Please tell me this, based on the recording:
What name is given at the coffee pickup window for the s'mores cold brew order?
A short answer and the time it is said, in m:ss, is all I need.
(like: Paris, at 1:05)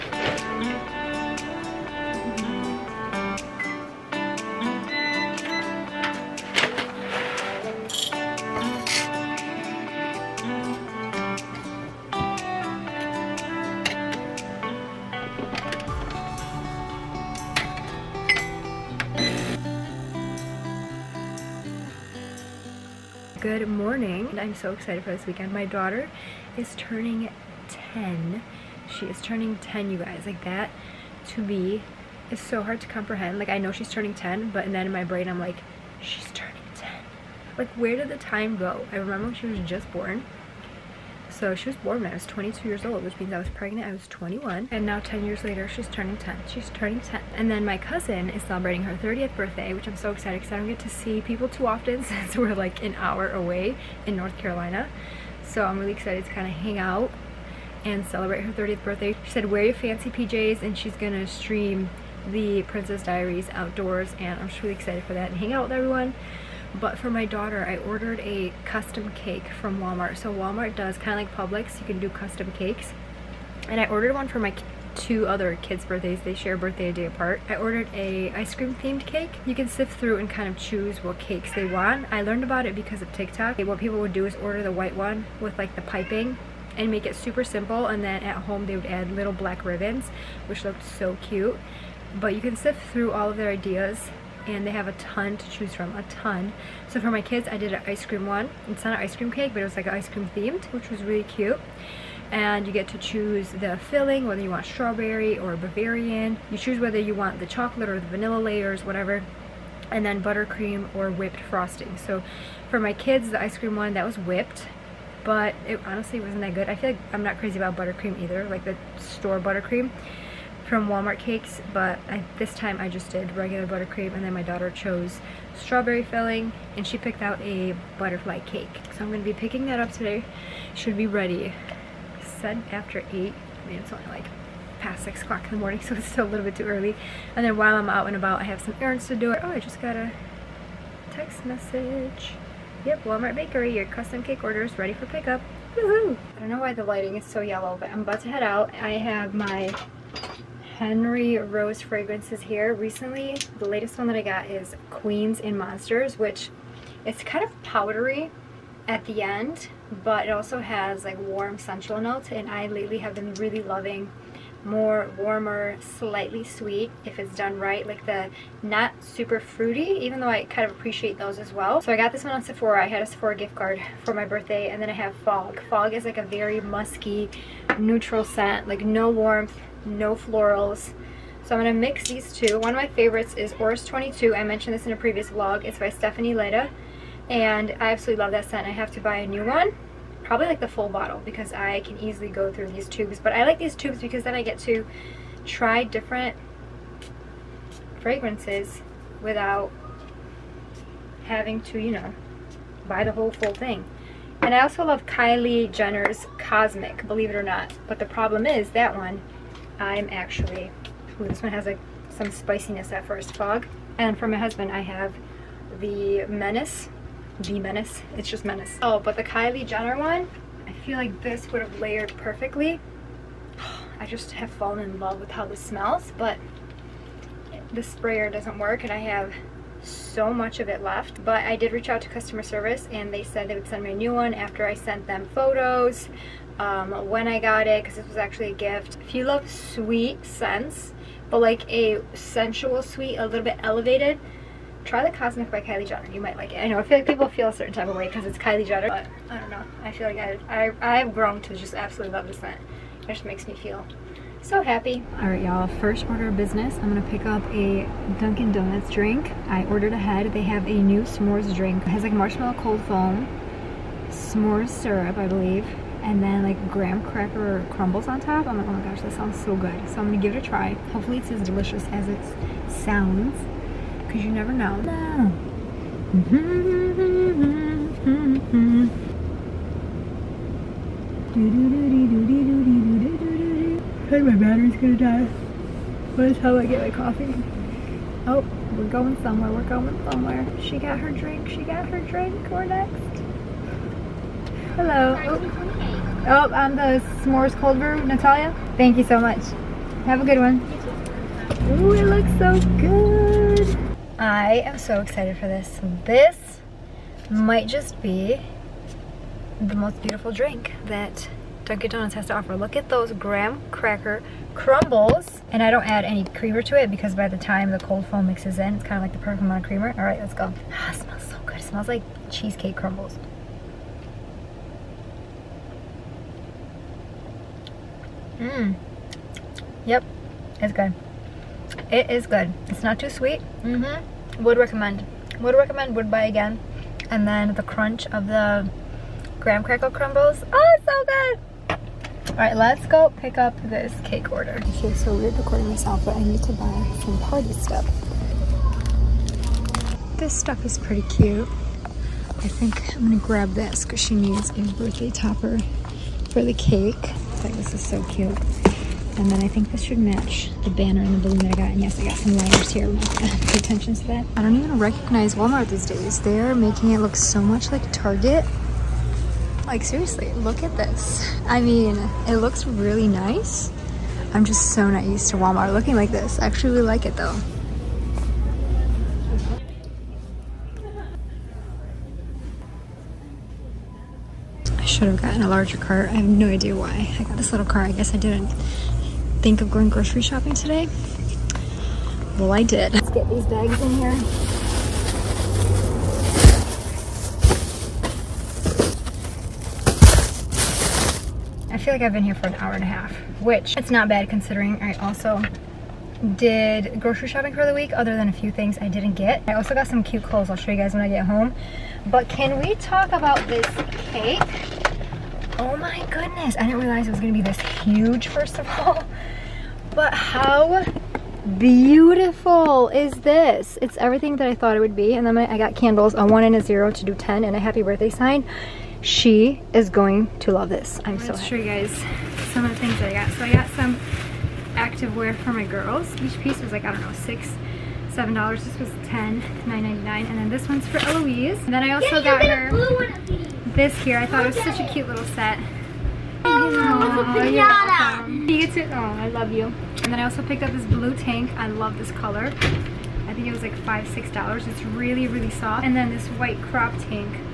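Natalya, at 4:58.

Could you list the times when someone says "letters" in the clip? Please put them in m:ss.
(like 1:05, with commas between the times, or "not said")
not said.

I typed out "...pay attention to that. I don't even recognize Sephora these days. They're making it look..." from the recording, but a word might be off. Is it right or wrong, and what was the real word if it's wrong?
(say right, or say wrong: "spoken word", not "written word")
wrong: "Walmart", not "Sephora".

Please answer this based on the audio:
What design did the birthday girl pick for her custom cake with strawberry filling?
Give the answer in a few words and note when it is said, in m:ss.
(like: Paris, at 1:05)
Butterfly, at 2:07.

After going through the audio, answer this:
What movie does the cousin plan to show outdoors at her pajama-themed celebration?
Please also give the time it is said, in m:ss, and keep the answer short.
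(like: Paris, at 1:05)
The Princess Diaries, at 1:02.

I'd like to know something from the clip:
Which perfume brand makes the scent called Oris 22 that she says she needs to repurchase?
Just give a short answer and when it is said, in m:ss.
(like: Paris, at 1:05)
Stephanie Leda, at 3:05.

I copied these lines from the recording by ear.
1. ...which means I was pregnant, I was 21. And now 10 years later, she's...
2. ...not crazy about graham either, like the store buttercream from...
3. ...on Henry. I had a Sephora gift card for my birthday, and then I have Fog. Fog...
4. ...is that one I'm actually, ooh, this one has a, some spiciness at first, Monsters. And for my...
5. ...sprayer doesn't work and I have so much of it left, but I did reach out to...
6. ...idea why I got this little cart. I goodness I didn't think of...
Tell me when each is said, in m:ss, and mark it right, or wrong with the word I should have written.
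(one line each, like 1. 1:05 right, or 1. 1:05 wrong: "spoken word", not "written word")
1. 0:43 right
2. 1:57 wrong: "buttercream", not "graham"
3. 2:52 wrong: "Sephora", not "Henry"
4. 3:28 wrong: "Fog", not "Monsters"
5. 3:47 right
6. 6:26 wrong: "guess", not "goodness".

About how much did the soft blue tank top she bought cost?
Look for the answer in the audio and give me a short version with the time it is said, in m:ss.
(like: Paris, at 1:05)
$5-6, at 7:33.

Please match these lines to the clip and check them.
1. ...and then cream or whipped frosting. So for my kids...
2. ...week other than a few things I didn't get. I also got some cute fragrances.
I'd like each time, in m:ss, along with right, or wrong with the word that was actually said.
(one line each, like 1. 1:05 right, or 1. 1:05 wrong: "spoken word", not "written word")
1. 1:49 wrong: "buttercream", not "cream"
2. 6:47 wrong: "clothes", not "fragrances".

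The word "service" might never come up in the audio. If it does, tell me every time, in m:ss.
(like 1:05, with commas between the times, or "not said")
3:52.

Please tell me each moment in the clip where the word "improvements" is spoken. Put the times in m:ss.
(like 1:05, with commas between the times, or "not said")
not said.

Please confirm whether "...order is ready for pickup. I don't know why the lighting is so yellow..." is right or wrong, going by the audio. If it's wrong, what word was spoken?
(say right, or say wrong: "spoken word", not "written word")
right.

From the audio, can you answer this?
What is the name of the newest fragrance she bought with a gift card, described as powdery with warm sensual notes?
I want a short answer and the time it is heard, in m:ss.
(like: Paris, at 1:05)
Queens and Monsters, at 2:34.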